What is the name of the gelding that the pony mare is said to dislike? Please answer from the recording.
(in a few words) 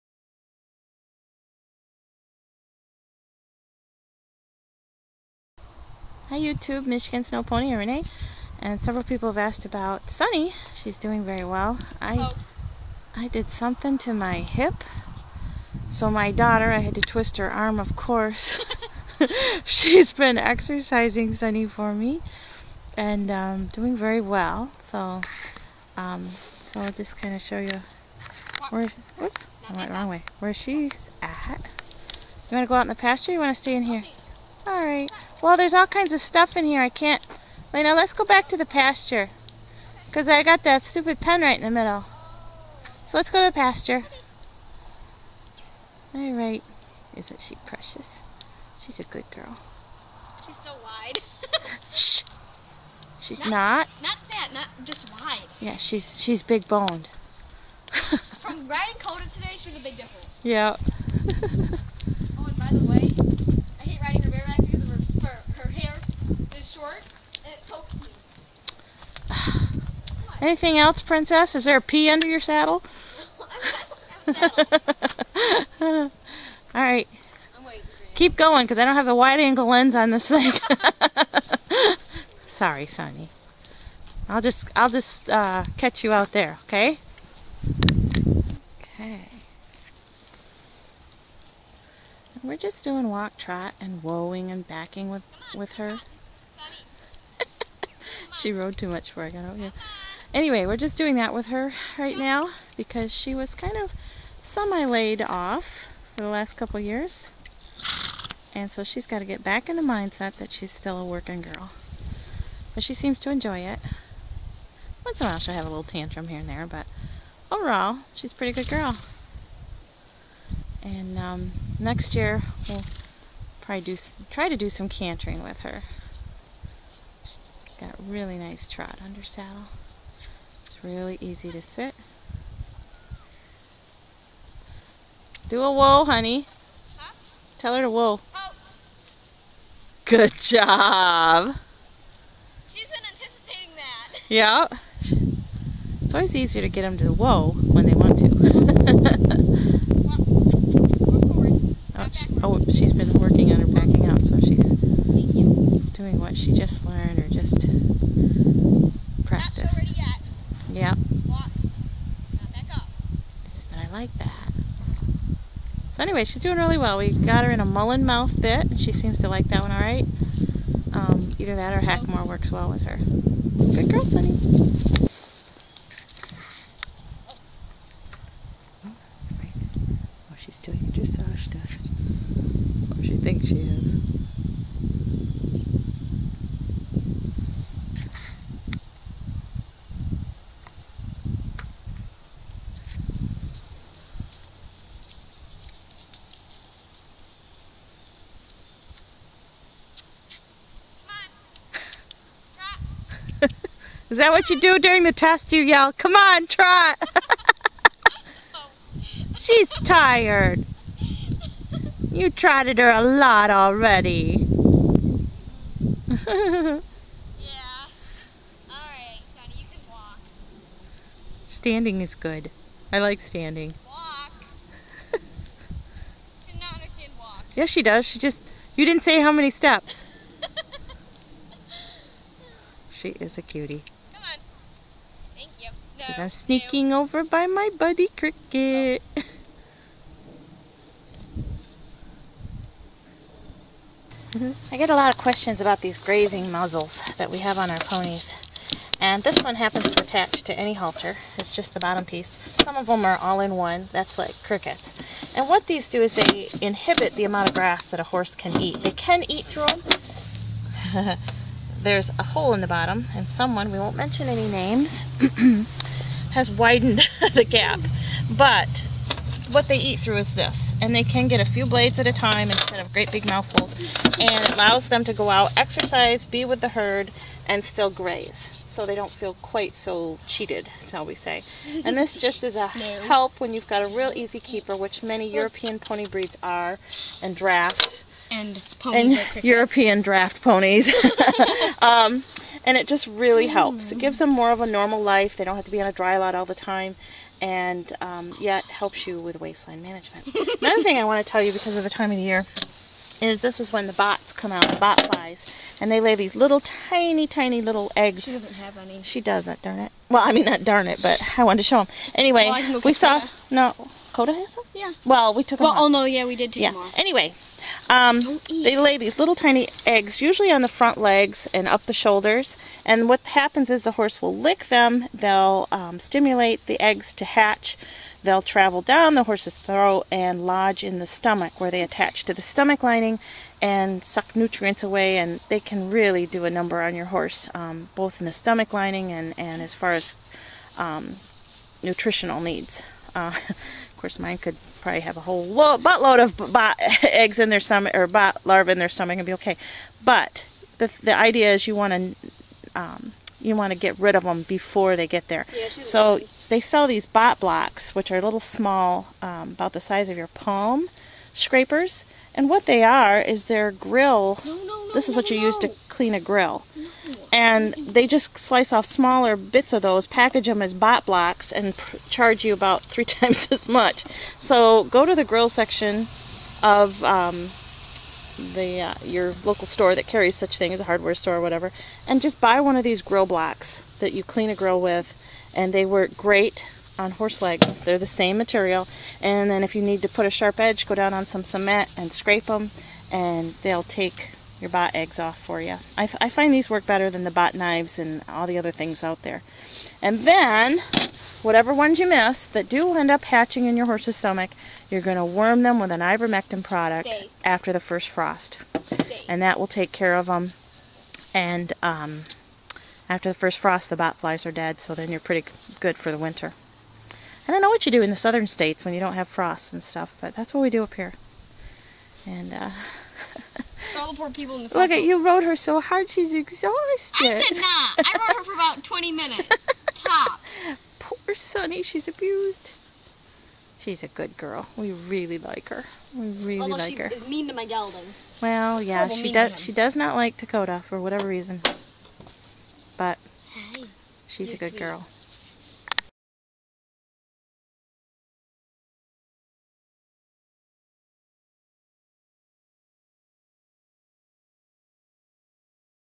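Dakota.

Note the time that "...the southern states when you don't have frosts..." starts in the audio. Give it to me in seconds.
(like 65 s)
418 s.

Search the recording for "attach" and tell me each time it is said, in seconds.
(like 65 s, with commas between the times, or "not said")
250 s, 331 s.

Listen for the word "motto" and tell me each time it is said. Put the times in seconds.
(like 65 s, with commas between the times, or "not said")
not said.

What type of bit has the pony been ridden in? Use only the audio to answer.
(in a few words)
Mullen mouth bit.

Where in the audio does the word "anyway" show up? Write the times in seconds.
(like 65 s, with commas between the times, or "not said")
100 s, 166 s, 312 s, 316 s.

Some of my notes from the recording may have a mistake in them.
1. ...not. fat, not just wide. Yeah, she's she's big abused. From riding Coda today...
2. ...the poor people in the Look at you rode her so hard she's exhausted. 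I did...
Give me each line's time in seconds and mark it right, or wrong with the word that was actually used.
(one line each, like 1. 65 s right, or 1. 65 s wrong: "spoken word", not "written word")
1. 54 s wrong: "boned", not "abused"
2. 424 s right.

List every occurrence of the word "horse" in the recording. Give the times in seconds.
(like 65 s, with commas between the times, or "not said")
258 s, 323 s, 329 s, 337 s, 387 s, 403 s.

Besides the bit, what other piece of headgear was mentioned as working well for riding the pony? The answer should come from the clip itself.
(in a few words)
Hackamore.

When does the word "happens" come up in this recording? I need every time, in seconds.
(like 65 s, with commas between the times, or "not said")
249 s, 323 s.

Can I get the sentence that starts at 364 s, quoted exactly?
No, no, no, this is what you use to clean a grill.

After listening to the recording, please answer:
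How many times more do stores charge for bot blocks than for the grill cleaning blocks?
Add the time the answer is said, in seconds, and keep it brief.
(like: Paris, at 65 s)
3 times, at 372 s.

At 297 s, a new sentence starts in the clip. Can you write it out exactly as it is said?
And um, helps you with line management.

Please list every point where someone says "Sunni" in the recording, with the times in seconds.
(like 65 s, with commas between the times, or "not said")
10 s, 21 s, 82 s, 174 s, 431 s.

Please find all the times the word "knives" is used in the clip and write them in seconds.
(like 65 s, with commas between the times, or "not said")
397 s.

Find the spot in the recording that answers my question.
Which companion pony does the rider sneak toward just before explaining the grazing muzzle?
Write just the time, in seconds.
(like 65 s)
238 s.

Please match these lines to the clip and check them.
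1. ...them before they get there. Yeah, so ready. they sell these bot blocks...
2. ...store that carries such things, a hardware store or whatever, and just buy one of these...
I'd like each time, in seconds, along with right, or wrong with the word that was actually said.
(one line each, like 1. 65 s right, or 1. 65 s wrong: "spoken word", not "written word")
1. 354 s right
2. 379 s right.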